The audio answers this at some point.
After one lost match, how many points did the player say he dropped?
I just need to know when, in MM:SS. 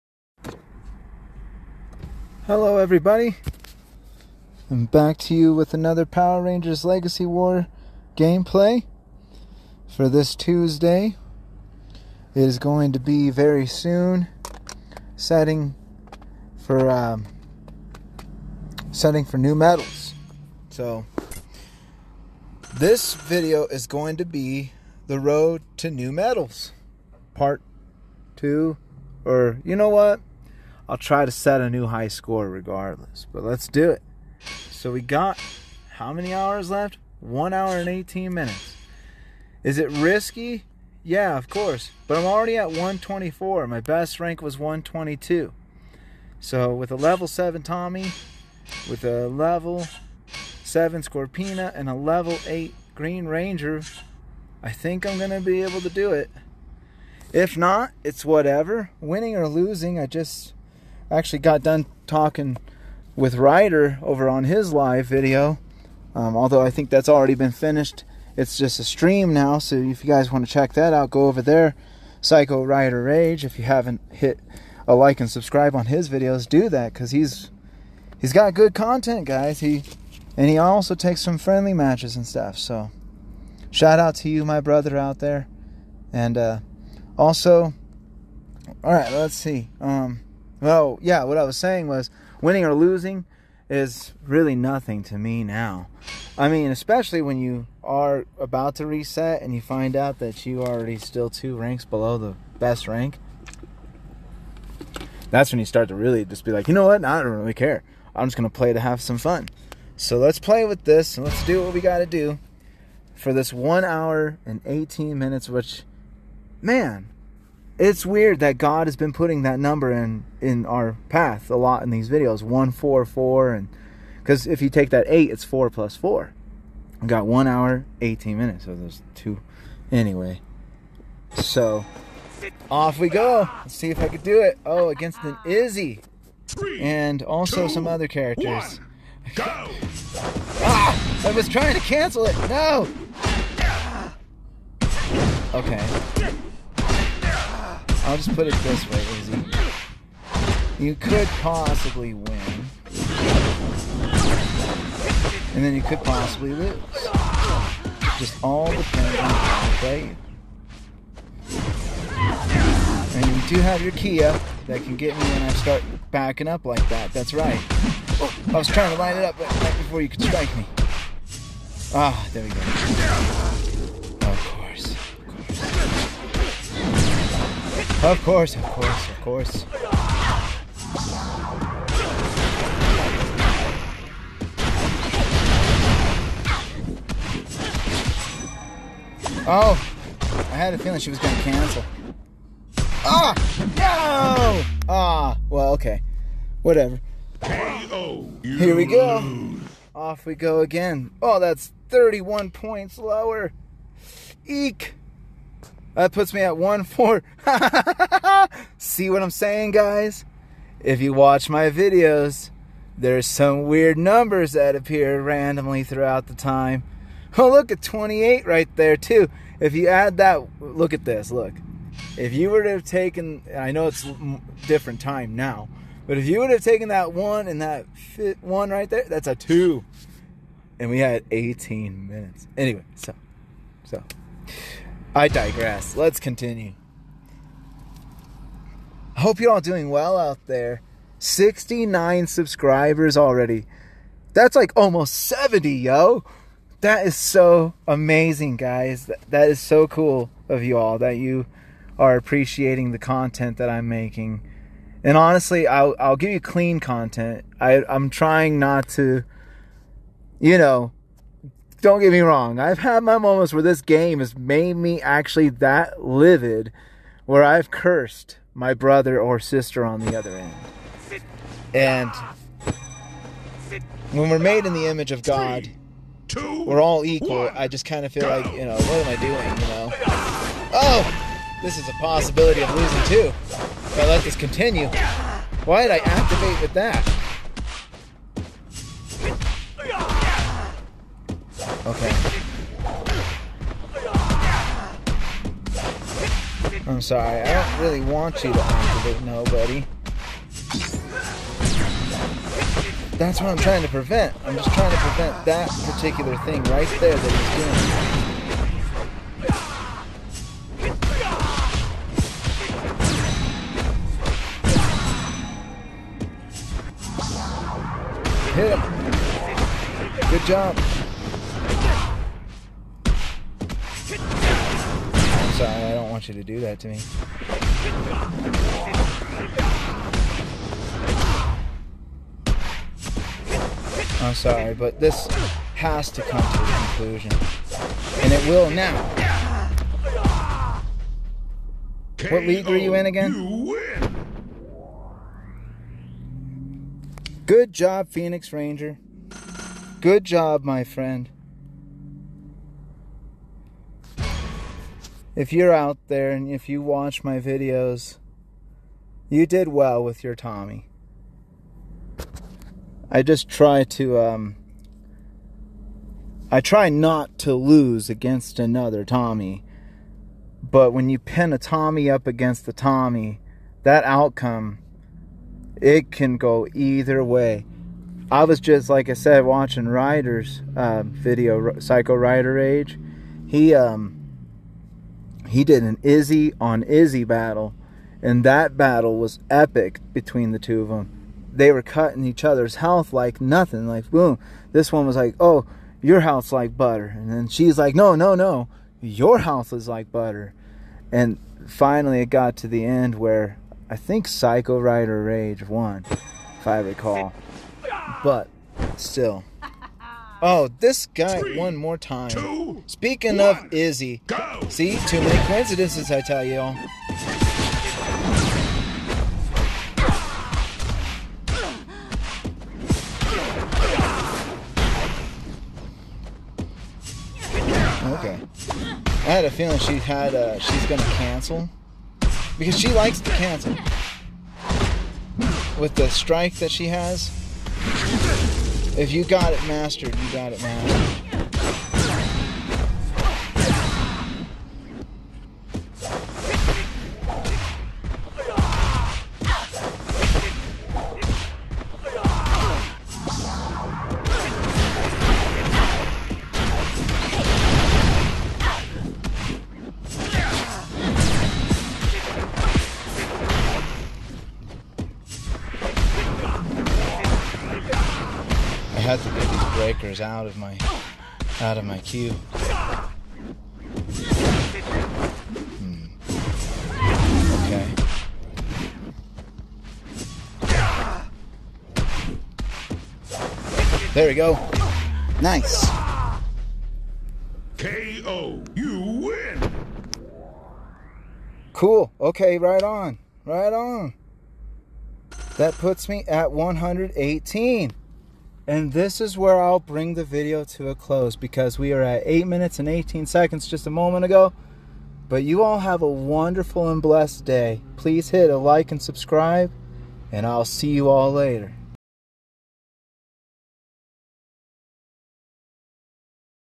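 03:21.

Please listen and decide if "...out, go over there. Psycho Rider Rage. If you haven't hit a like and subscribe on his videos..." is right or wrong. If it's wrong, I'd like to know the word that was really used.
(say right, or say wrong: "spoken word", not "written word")
right.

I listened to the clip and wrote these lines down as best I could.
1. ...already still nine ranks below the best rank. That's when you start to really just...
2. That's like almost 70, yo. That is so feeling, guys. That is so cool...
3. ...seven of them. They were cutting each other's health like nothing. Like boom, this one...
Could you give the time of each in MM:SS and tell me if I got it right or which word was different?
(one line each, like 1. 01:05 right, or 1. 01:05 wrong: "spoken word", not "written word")
1. 01:40 wrong: "two", not "nine"
2. 04:04 wrong: "amazing", not "feeling"
3. 06:30 wrong: "two", not "seven".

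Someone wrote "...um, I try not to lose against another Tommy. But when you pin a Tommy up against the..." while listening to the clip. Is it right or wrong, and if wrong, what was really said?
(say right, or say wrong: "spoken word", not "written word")
right.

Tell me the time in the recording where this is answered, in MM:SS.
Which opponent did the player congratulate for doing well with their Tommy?
05:48.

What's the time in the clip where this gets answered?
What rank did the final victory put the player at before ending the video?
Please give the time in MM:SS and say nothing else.
08:16.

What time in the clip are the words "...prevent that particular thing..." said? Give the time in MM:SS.
05:04.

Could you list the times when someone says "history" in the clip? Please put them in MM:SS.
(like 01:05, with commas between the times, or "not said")
not said.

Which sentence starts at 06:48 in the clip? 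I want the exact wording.
But still, Oh, this guy Three, one more time.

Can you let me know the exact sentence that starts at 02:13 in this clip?
Let's see if I could do it.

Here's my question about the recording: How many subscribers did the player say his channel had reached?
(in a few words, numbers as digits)
69.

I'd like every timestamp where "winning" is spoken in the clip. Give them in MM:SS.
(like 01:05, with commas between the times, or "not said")
00:58, 01:32.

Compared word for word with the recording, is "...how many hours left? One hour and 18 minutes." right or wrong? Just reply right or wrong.
right.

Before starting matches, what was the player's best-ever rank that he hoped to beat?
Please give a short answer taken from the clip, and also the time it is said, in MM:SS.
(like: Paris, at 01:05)
122, at 00:44.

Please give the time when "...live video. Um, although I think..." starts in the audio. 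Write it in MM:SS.
01:04.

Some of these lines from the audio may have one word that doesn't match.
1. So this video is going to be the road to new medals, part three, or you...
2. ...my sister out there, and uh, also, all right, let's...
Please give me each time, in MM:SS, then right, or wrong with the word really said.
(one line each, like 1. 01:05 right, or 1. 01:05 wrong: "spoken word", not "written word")
1. 00:20 wrong: "two", not "three"
2. 01:24 wrong: "brother", not "sister".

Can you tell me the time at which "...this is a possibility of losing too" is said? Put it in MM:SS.
04:41.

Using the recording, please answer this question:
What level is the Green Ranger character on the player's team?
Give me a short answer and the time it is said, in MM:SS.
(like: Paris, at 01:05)
8, at 00:51.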